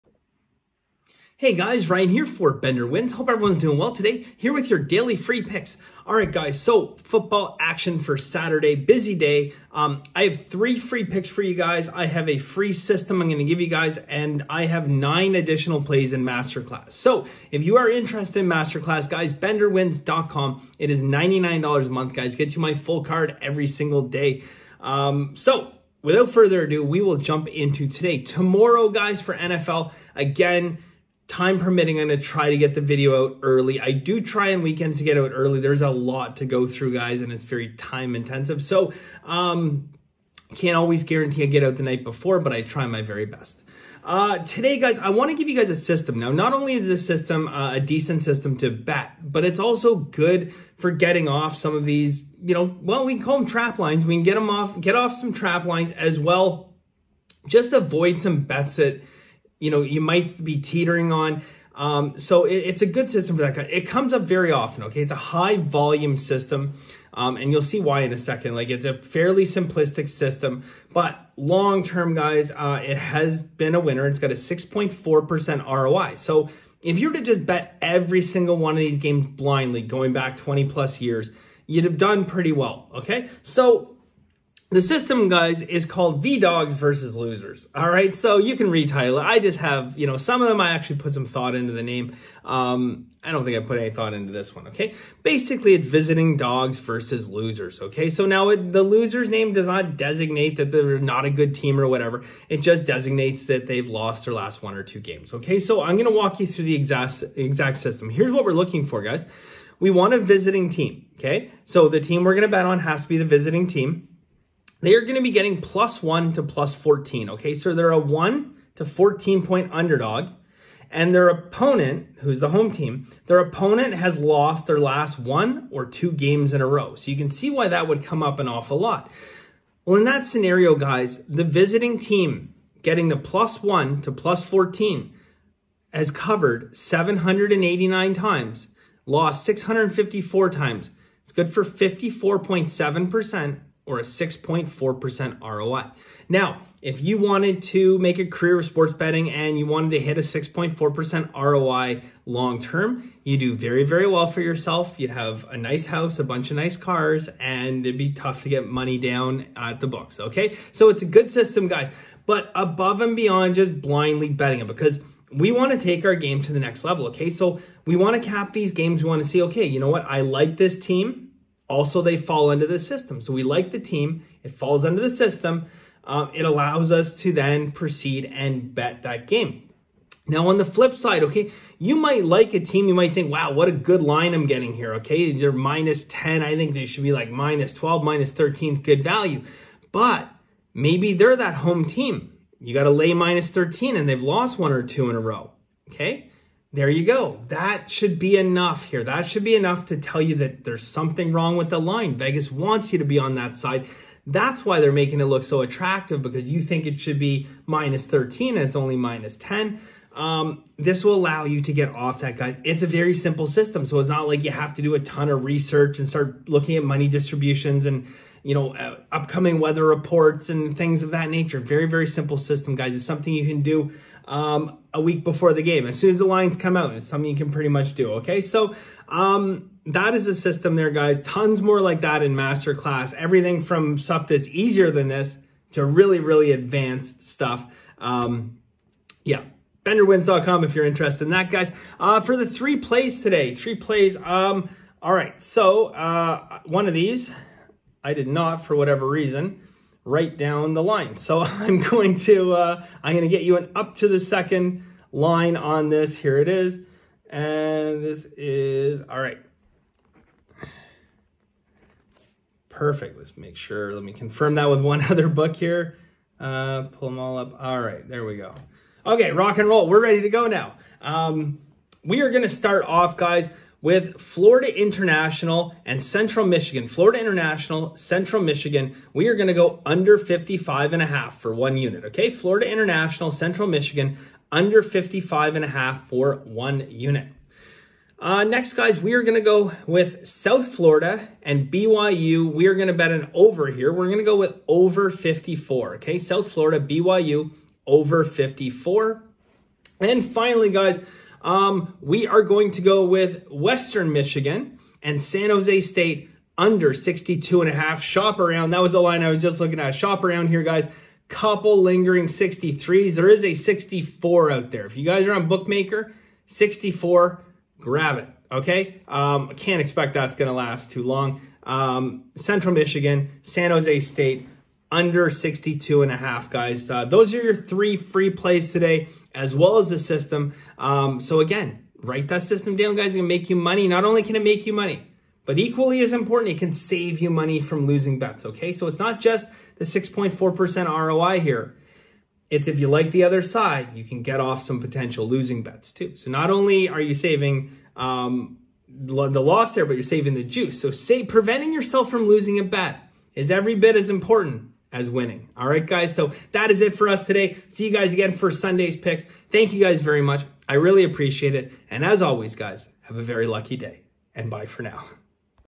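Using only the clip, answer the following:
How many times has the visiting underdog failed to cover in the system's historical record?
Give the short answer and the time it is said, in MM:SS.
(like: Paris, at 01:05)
654, at 02:19.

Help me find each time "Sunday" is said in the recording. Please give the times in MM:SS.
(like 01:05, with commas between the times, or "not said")
05:58.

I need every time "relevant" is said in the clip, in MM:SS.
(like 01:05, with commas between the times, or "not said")
not said.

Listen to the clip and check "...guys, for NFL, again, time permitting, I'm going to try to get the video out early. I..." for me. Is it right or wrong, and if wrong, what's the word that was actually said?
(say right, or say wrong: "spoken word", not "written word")
right.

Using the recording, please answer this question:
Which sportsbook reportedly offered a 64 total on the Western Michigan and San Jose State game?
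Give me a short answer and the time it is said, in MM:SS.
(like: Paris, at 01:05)
Bookmaker, at 05:15.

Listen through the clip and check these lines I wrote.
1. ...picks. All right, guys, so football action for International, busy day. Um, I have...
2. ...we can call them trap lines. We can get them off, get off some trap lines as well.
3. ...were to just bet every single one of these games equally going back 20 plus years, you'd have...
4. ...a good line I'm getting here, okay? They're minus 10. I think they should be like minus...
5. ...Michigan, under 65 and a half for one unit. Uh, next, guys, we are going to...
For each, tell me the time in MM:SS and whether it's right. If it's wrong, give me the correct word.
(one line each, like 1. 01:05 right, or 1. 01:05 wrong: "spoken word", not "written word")
1. 00:05 wrong: "Saturday", not "International"
2. 00:53 right
3. 01:17 wrong: "blindly", not "equally"
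4. 03:03 right
5. 04:43 wrong: "55", not "65".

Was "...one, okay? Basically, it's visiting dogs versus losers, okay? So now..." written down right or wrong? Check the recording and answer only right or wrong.
right.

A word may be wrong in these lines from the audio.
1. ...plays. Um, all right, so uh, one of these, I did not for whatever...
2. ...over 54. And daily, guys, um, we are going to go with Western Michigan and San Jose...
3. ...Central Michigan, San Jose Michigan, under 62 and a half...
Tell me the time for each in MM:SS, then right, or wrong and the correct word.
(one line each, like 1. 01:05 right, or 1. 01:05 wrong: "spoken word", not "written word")
1. 04:03 right
2. 04:57 wrong: "finally", not "daily"
3. 05:22 wrong: "State", not "Michigan".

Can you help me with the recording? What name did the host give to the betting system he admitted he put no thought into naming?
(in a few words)
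V-Dogs versus Losers.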